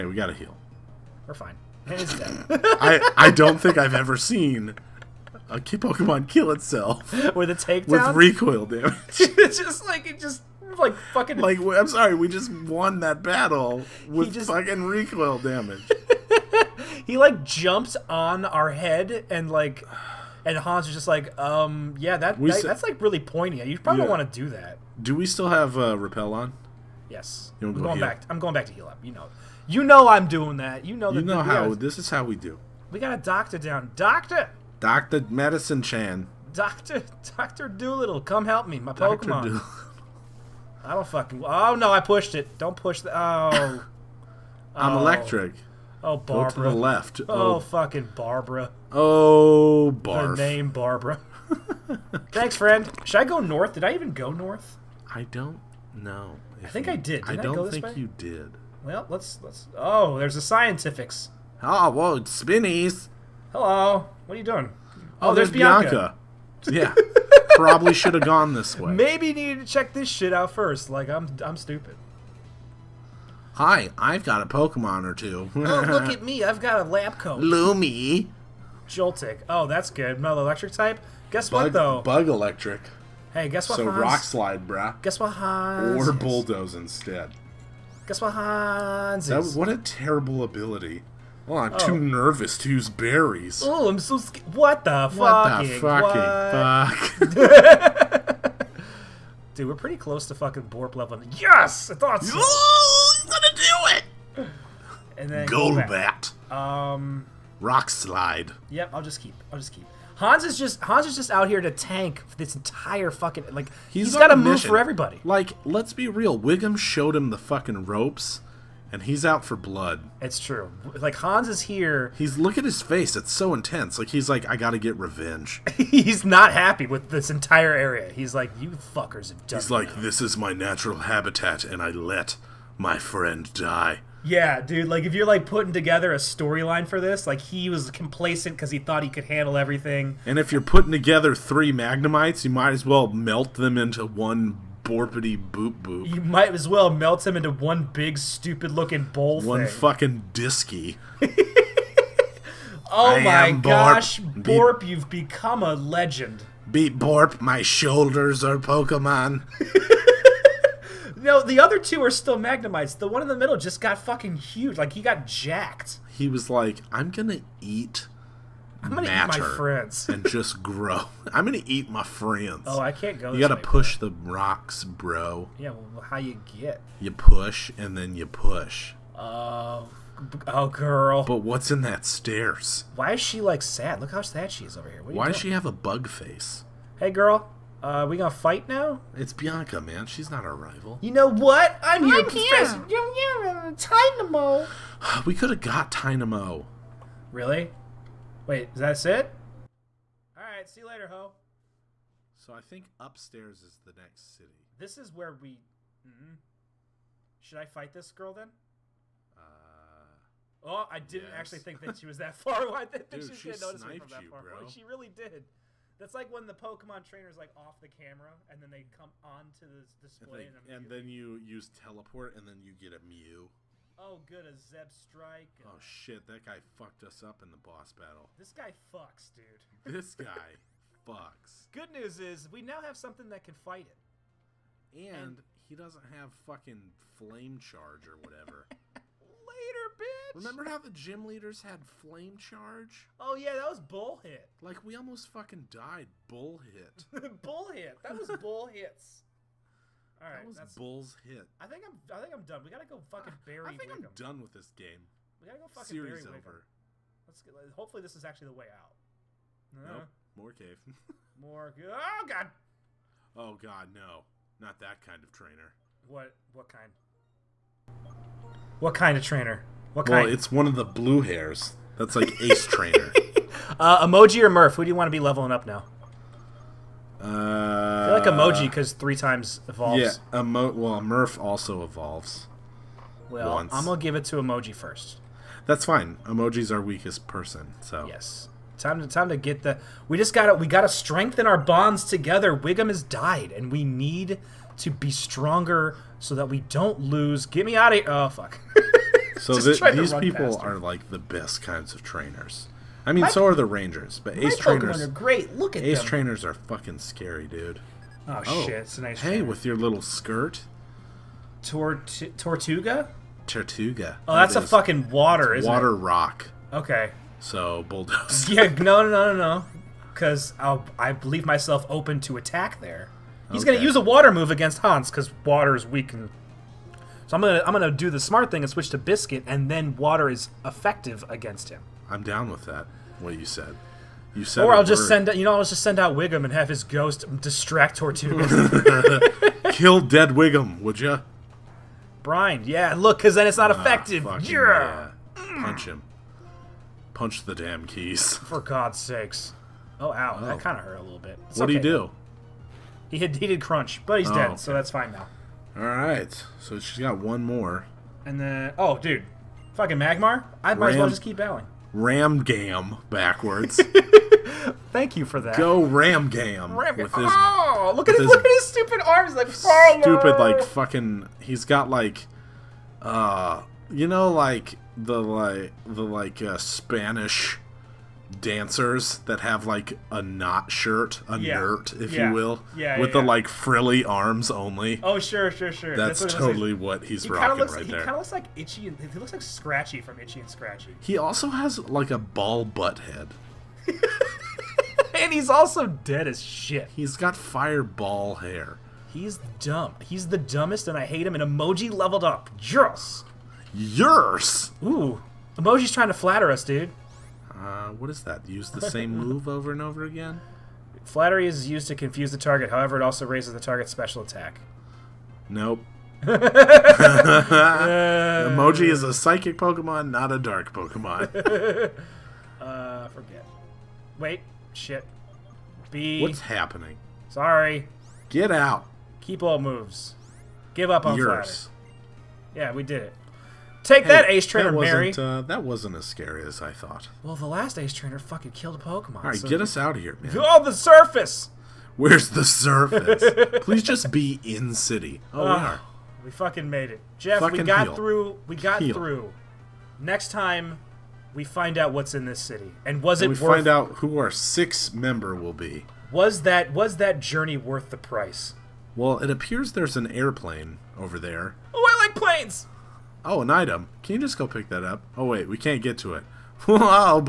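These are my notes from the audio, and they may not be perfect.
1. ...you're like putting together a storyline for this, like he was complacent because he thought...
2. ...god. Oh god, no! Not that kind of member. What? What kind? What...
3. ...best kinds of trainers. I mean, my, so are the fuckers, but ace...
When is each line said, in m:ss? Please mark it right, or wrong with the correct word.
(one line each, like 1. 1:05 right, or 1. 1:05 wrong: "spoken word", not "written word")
1. 2:15 right
2. 4:22 wrong: "trainer", not "member"
3. 5:01 wrong: "rangers", not "fuckers".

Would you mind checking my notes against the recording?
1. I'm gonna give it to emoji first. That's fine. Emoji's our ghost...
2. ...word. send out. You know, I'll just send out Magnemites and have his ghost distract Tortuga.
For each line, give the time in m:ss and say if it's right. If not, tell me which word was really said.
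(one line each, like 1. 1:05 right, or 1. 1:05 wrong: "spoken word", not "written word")
1. 4:43 wrong: "weakest", not "ghost"
2. 5:35 wrong: "Wiggum", not "Magnemites".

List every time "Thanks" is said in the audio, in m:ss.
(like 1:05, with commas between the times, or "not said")
0:52, 6:04.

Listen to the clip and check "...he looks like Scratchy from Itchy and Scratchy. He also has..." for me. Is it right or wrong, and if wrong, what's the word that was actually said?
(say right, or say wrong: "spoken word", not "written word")
right.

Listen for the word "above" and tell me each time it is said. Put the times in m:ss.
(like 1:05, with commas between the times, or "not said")
not said.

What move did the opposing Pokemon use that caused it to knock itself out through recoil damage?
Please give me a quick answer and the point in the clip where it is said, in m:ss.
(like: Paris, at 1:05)
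Takedown, at 0:07.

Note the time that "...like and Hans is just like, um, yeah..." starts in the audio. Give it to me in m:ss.
0:19.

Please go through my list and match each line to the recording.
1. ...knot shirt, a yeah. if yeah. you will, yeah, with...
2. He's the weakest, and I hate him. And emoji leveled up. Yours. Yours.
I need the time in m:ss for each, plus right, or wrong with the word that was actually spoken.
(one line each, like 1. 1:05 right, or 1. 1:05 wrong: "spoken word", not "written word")
1. 6:20 right
2. 6:40 wrong: "dumbest", not "weakest".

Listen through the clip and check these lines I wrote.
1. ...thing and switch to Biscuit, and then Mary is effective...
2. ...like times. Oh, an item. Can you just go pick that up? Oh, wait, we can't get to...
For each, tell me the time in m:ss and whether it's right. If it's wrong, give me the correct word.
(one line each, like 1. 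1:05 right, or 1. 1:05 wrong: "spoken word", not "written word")
1. 5:28 wrong: "Water", not "Mary"
2. 7:42 wrong: "planes", not "times".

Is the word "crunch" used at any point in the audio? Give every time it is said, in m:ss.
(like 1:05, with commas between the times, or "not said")
5:53.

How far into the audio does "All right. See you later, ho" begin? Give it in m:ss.
3:20.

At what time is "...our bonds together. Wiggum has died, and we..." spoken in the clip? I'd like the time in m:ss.
4:51.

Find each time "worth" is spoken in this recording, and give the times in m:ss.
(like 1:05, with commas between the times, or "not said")
7:33, 7:37.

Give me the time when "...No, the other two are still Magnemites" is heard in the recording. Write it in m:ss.
2:41.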